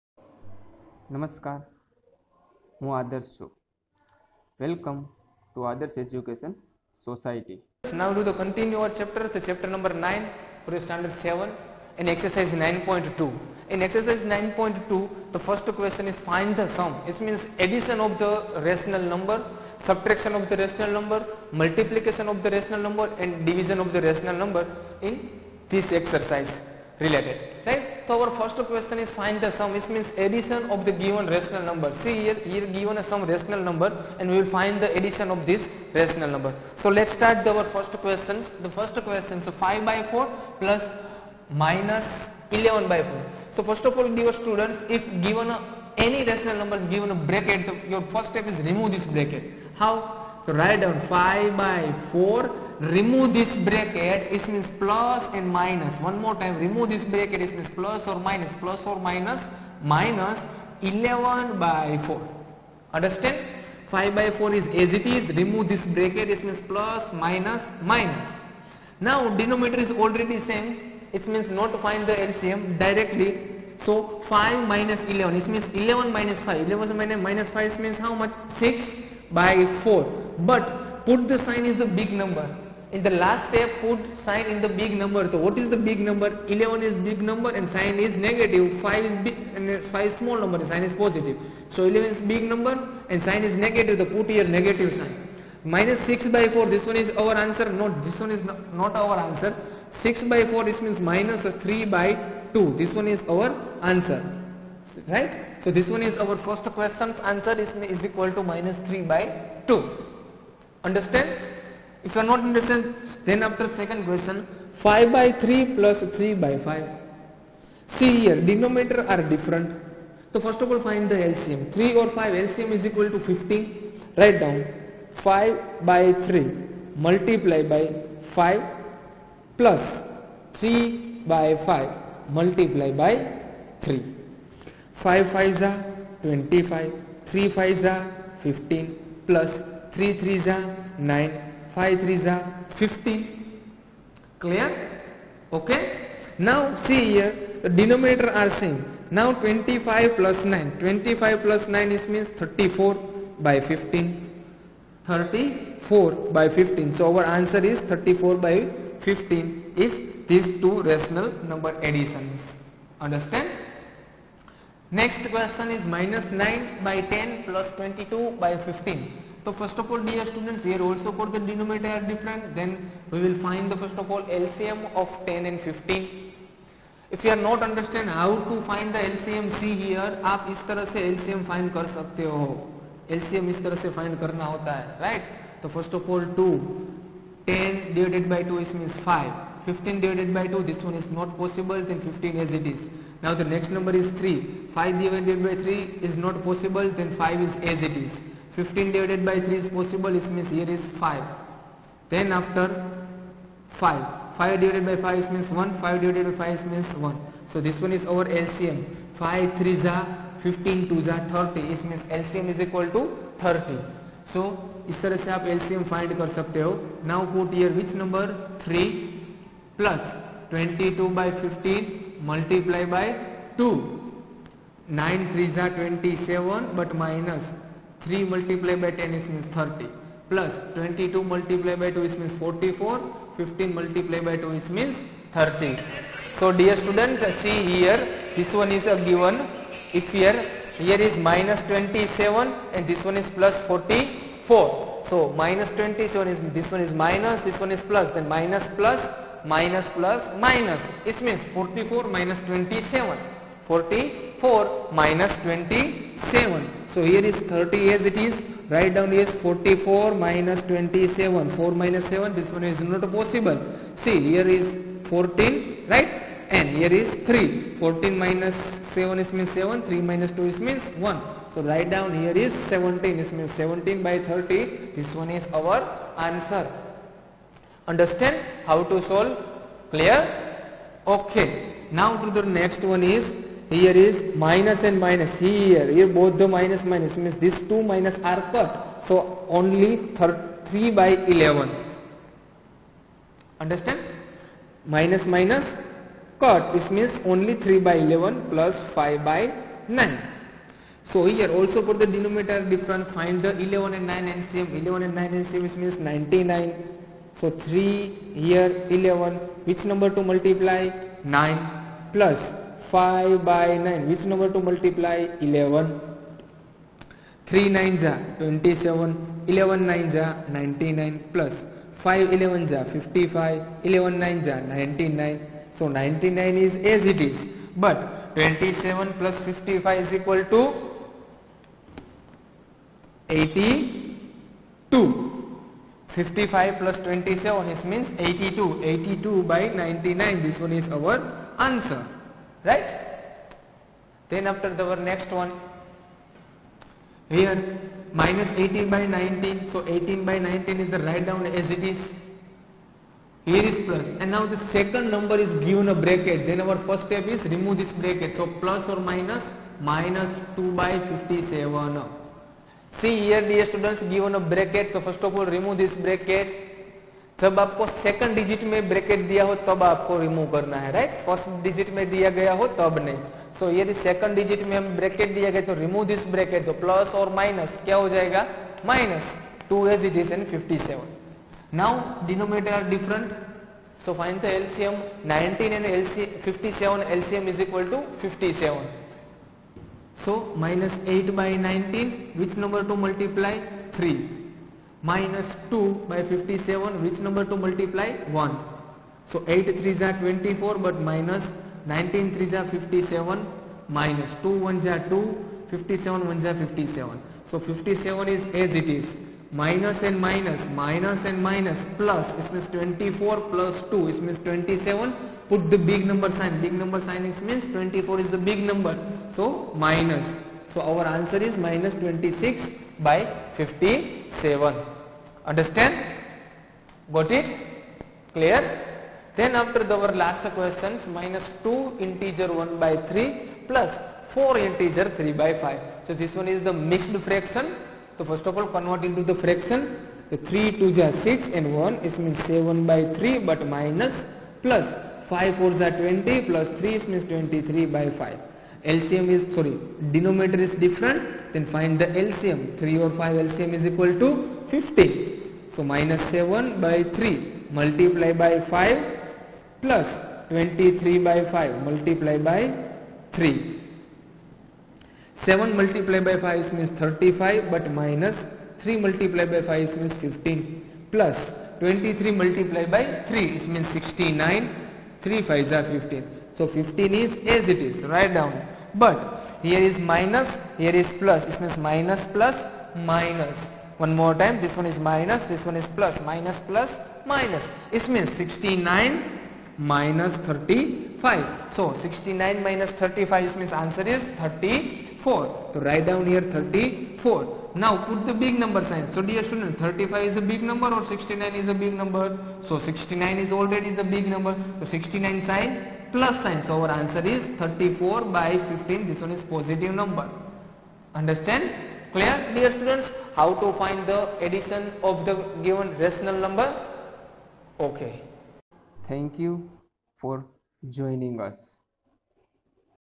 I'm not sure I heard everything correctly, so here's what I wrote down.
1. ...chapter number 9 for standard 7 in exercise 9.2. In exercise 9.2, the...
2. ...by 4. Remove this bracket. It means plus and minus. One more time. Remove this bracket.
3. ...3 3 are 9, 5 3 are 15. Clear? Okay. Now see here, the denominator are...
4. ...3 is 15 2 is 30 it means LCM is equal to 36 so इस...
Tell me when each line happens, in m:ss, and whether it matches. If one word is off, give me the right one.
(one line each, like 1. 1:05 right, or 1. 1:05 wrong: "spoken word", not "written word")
1. 0:09 right
2. 0:51 right
3. 2:19 right
4. 3:29 wrong: "30", not "36".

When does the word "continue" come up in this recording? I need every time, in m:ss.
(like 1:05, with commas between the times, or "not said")
0:08.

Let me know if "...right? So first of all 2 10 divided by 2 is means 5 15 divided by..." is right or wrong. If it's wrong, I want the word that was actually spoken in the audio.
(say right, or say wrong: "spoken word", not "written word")
right.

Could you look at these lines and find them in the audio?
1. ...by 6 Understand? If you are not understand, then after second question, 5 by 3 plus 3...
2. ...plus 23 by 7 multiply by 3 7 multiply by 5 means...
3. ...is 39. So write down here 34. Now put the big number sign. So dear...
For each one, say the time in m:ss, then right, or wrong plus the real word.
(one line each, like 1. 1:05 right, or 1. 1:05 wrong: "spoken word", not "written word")
1. 1:49 wrong: "2", not "6"
2. 7:39 wrong: "5", not "7"
3. 8:14 wrong: "34", not "39".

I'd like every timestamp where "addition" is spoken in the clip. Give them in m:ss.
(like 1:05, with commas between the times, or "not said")
0:17, 0:30, 0:34, 2:41, 8:34.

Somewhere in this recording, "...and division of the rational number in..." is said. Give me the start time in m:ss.
0:23.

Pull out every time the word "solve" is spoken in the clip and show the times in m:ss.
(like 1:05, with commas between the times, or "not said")
4:39.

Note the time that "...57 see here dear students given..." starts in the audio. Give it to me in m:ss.
6:01.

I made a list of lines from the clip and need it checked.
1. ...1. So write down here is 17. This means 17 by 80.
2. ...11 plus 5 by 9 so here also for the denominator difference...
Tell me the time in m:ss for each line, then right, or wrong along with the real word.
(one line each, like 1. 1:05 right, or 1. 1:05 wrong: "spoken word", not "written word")
1. 4:31 wrong: "30", not "80"
2. 4:57 right.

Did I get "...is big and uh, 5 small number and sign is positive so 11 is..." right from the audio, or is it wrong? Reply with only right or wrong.
right.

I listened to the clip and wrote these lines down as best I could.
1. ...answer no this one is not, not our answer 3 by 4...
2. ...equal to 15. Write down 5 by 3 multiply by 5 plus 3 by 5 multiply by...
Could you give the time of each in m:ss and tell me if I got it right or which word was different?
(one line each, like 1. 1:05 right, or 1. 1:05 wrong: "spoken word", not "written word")
1. 1:37 wrong: "6", not "3"
2. 2:02 right.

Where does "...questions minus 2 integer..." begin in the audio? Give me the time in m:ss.
7:10.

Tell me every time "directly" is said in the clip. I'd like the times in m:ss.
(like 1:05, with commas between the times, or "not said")
1:12.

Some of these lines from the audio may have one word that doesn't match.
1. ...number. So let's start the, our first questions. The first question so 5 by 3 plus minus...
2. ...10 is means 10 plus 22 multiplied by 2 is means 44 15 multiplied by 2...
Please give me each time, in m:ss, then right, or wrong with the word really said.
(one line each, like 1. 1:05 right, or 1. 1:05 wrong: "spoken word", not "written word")
1. 0:36 wrong: "4", not "3"
2. 3:48 wrong: "30", not "10".